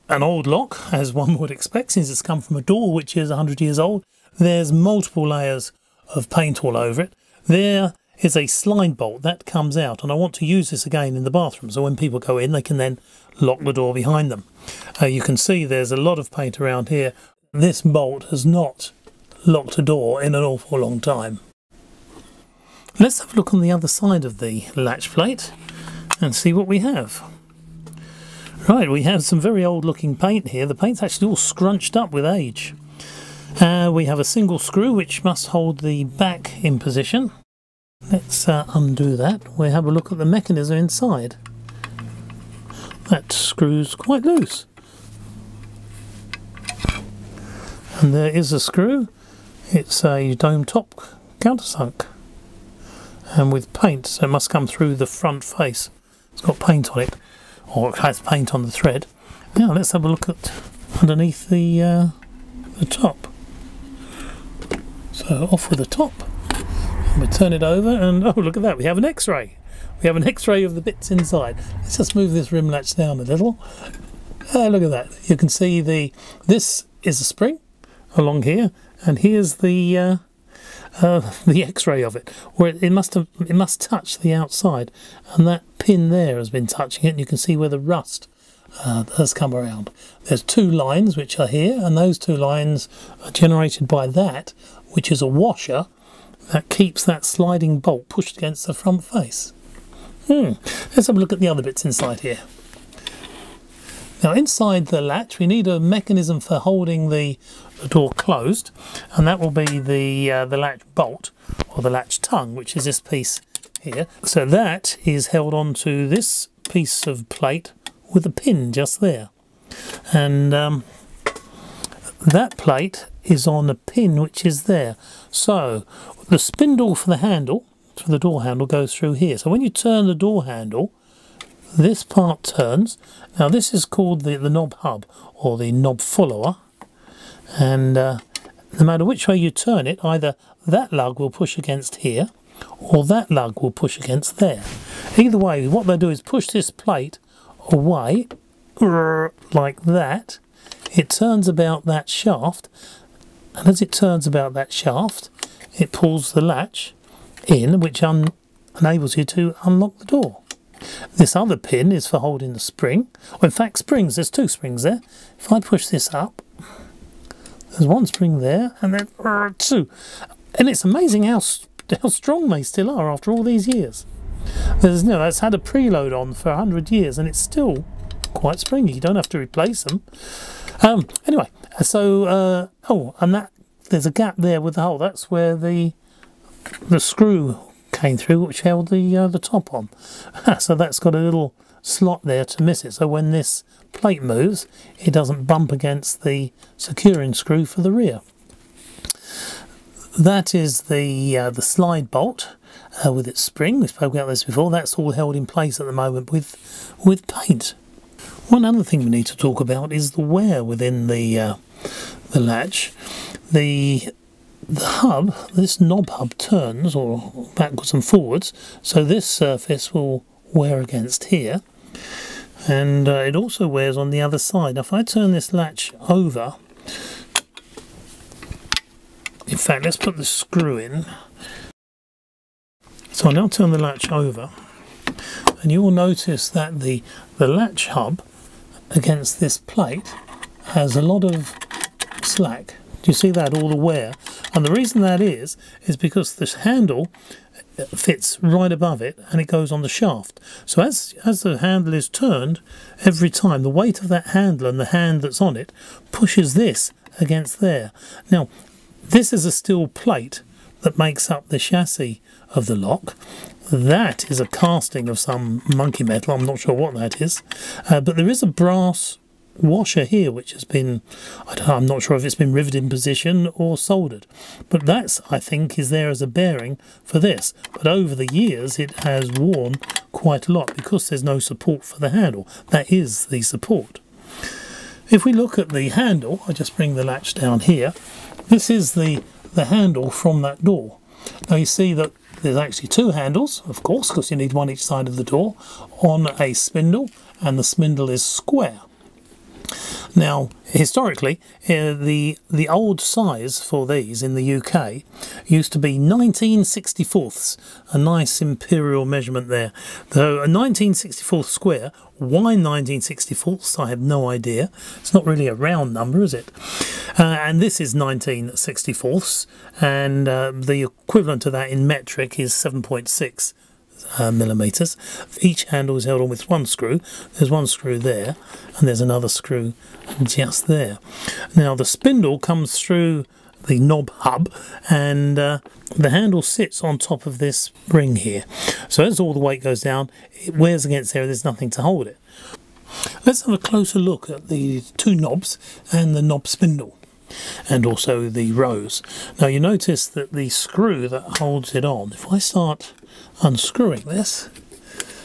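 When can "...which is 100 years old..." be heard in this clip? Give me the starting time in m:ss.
0:02.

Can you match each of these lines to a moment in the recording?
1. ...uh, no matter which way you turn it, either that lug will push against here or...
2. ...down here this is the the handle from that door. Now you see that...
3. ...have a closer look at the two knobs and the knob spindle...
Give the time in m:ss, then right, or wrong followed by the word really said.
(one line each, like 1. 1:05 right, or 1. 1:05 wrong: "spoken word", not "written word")
1. 2:17 right
2. 4:47 right
3. 5:43 right.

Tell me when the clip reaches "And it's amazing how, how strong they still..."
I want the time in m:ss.
2:50.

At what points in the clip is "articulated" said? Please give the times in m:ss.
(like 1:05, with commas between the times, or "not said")
not said.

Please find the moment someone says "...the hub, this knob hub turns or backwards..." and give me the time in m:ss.
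3:34.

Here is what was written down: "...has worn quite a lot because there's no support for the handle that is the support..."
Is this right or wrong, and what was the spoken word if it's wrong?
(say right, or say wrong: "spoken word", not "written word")
right.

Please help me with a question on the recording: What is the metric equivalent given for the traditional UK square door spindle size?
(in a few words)
7.6 mm.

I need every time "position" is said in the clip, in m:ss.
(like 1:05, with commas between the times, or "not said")
0:36, 4:32.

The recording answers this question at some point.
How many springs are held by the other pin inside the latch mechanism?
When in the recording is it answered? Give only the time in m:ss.
2:44.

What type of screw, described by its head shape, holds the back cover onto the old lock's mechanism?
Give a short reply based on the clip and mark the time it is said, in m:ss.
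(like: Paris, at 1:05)
Dome top countersunk, at 0:50.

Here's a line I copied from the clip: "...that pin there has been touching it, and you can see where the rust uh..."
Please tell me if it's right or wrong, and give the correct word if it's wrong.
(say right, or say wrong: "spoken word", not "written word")
right.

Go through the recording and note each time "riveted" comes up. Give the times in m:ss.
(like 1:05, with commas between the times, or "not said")
4:32.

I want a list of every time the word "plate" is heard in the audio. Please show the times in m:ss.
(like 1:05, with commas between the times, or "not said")
0:25, 1:57, 2:02, 2:26, 3:13, 3:59, 4:19.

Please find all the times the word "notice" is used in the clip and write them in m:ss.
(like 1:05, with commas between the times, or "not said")
3:55, 5:49.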